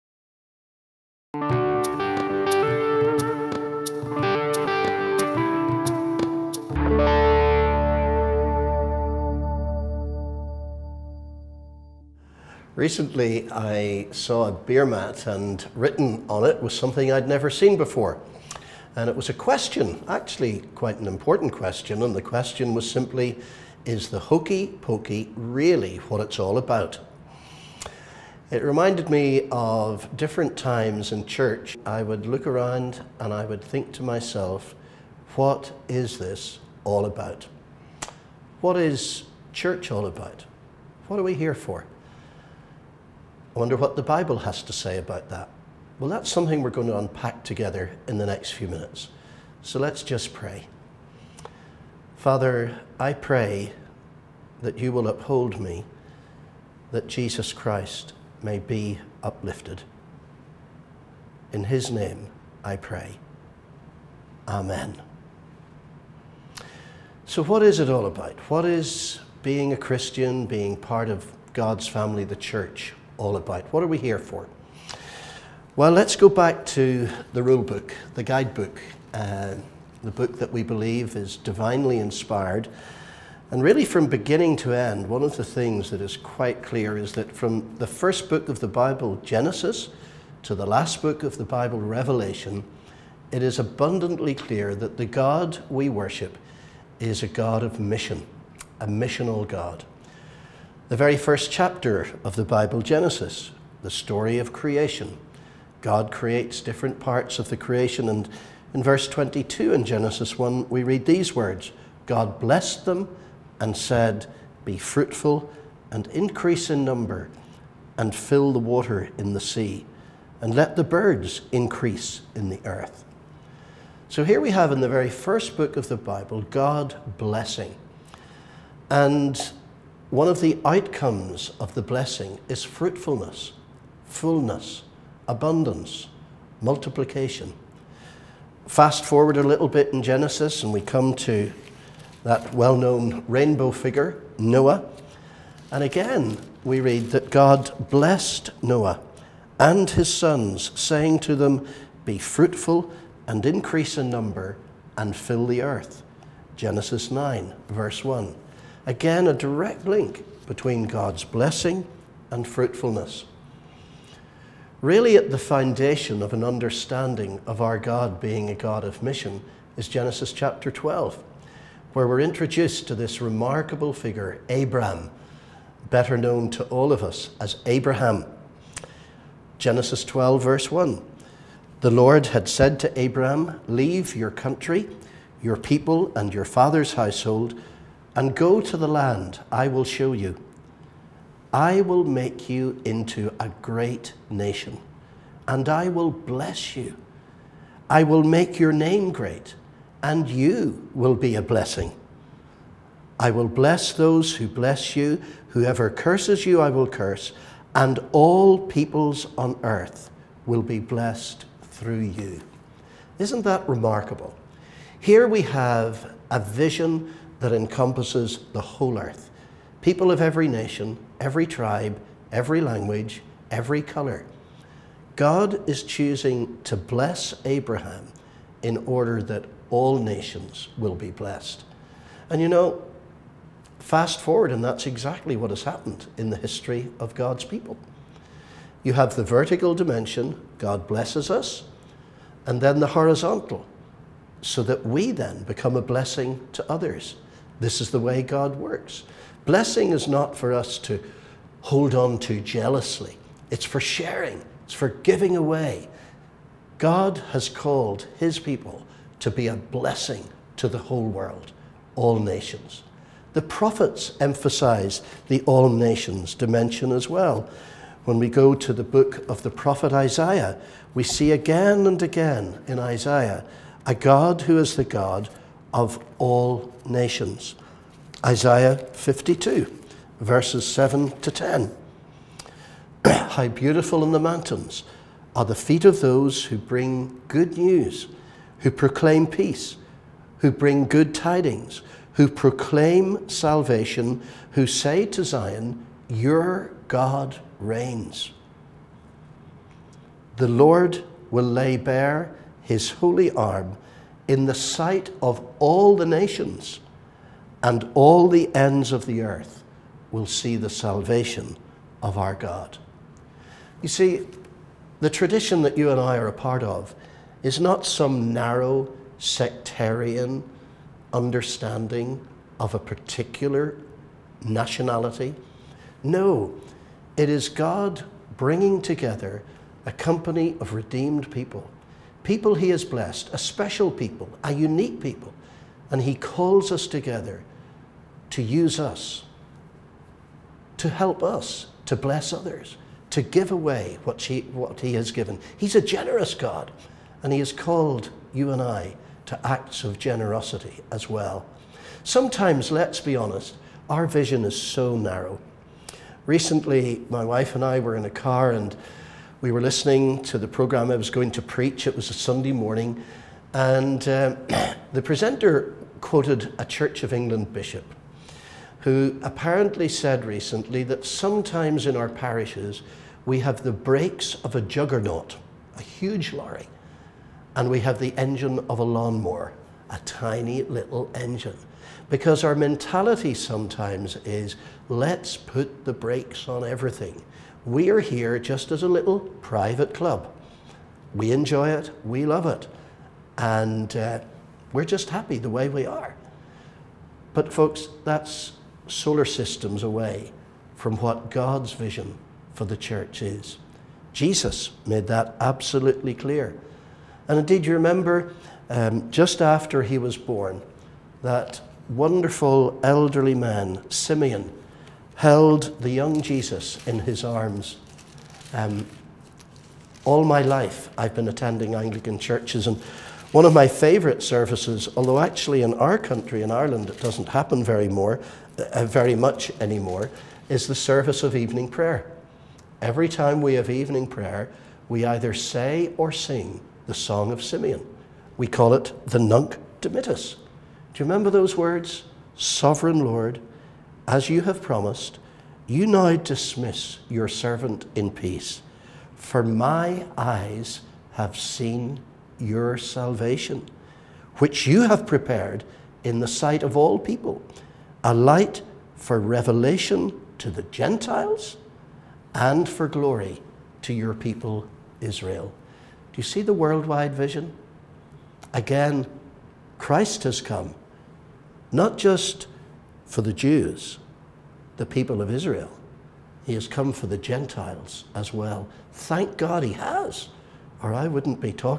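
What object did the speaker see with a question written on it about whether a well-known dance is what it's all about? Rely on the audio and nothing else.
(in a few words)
Beer mat.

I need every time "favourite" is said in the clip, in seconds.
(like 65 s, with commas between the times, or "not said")
423 s.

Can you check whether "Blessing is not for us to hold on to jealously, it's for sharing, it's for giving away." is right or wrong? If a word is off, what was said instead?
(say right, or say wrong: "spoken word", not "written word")
right.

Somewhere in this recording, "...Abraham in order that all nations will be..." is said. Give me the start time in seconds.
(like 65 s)
227 s.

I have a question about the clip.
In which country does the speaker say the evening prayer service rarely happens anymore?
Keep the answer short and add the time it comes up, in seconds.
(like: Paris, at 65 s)
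Ireland, at 426 s.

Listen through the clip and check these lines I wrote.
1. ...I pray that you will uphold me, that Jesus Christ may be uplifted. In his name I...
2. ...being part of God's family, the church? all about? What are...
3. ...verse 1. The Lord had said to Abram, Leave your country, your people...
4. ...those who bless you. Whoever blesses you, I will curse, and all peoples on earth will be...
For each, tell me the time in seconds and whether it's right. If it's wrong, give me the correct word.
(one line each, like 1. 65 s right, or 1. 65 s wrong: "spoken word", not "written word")
1. 52 s right
2. 70 s right
3. 180 s right
4. 203 s wrong: "curses", not "blesses".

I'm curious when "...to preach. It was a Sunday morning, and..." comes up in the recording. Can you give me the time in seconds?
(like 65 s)
361 s.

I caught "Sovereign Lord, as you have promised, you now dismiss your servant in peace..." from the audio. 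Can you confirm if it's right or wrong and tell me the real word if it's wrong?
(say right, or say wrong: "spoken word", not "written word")
right.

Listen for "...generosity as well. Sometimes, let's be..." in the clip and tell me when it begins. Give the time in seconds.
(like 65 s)
349 s.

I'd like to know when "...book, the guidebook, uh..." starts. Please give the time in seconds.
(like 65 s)
77 s.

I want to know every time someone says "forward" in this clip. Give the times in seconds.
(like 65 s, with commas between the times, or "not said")
139 s, 234 s.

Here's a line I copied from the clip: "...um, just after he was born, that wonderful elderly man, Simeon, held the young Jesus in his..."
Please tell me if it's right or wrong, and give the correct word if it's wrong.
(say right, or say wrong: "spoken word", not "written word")
right.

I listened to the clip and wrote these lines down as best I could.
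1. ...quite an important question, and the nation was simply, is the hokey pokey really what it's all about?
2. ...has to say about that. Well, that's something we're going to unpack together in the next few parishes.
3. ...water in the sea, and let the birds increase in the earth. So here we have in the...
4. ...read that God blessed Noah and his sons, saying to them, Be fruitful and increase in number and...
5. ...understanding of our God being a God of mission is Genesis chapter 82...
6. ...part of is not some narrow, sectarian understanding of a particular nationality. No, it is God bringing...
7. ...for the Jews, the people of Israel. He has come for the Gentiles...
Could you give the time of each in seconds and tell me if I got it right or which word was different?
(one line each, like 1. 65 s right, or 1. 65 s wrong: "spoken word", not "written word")
1. 20 s wrong: "question", not "nation"
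2. 44 s wrong: "minutes", not "parishes"
3. 118 s right
4. 146 s right
5. 166 s wrong: "12", not "82"
6. 316 s right
7. 473 s right.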